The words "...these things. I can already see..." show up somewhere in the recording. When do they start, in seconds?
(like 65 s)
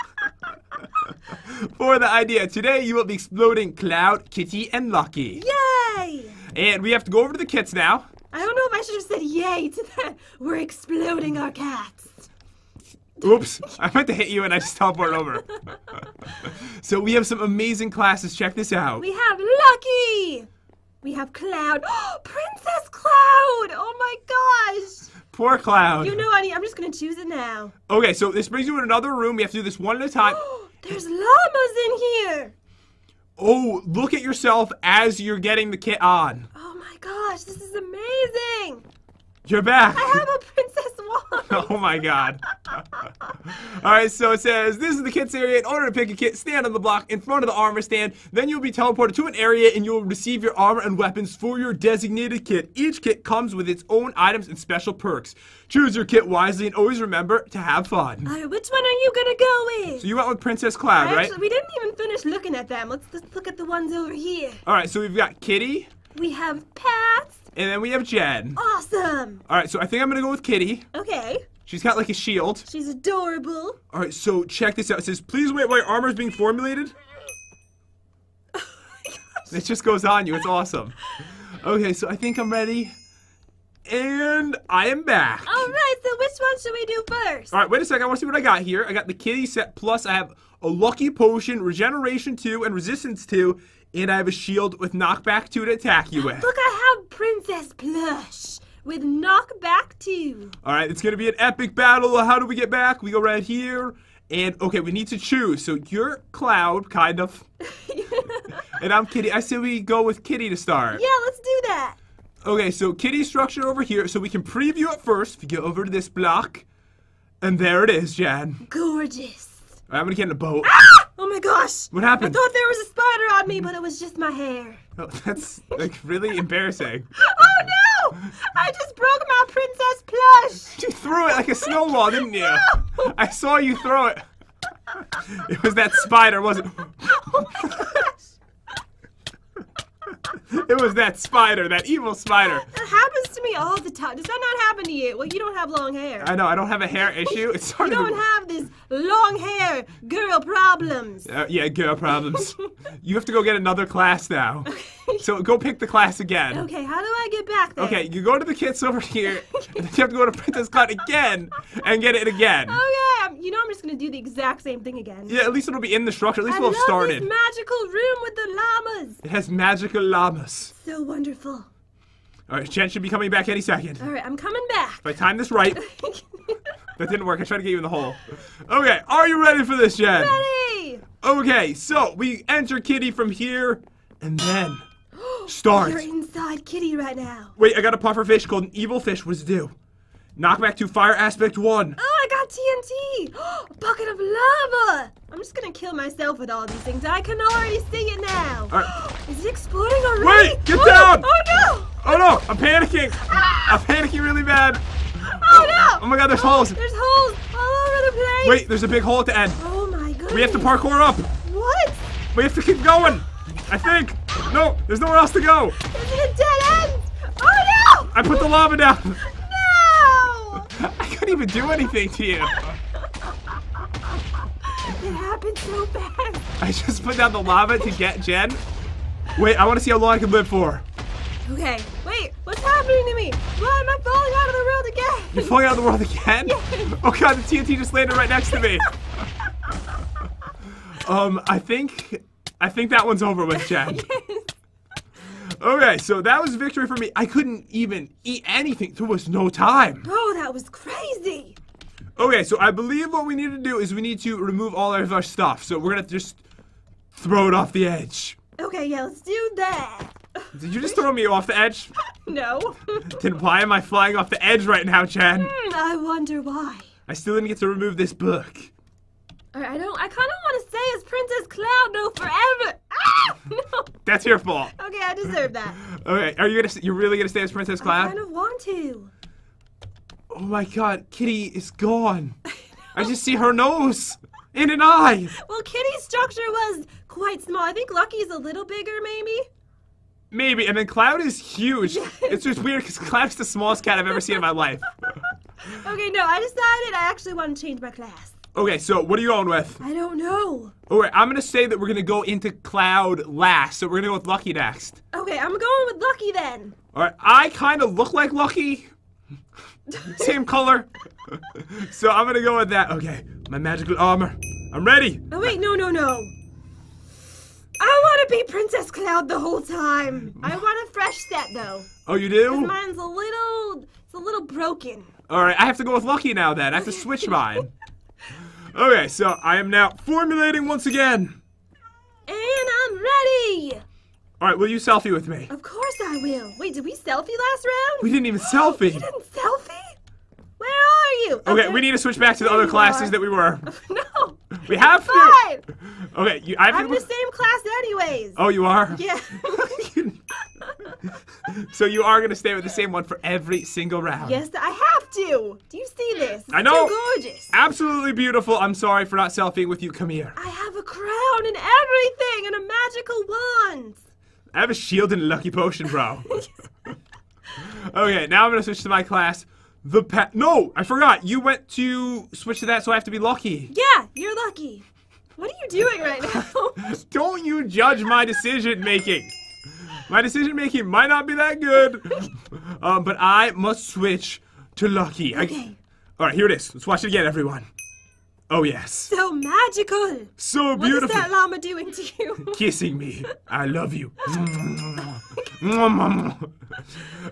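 196 s.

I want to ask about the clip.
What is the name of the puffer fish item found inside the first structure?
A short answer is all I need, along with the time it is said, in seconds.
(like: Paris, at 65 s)
evil fish, at 188 s.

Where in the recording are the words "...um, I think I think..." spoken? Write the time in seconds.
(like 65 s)
241 s.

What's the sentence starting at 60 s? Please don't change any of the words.
So you went with Princess Cloud, right?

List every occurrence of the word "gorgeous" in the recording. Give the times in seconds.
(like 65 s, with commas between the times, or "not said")
118 s, 357 s.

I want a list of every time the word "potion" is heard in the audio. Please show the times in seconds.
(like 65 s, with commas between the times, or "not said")
91 s, 365 s.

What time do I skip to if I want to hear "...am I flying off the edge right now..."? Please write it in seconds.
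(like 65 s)
263 s.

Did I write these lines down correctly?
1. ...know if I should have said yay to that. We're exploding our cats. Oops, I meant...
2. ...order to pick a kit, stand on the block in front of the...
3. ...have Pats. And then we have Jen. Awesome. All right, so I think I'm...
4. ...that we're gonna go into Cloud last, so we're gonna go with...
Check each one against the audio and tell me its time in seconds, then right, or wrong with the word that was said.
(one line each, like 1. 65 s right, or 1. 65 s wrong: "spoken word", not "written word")
1. 8 s right
2. 45 s right
3. 66 s right
4. 301 s right.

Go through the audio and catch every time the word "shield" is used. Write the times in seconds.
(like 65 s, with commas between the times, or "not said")
72 s, 94 s, 364 s.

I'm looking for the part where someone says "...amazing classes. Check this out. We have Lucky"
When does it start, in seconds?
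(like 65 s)
17 s.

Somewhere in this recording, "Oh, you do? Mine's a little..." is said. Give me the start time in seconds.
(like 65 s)
322 s.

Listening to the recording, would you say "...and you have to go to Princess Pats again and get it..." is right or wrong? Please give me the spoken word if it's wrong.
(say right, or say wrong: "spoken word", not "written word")
wrong: "Cut", not "Pats".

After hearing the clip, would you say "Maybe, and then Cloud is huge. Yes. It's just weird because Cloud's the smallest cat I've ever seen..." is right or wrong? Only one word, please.
right.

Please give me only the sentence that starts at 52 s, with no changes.
Each kit comes with its own items and special perks.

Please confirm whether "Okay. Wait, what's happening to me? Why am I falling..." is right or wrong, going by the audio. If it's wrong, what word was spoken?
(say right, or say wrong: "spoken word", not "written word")
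right.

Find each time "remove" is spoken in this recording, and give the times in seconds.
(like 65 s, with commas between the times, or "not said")
254 s, 267 s.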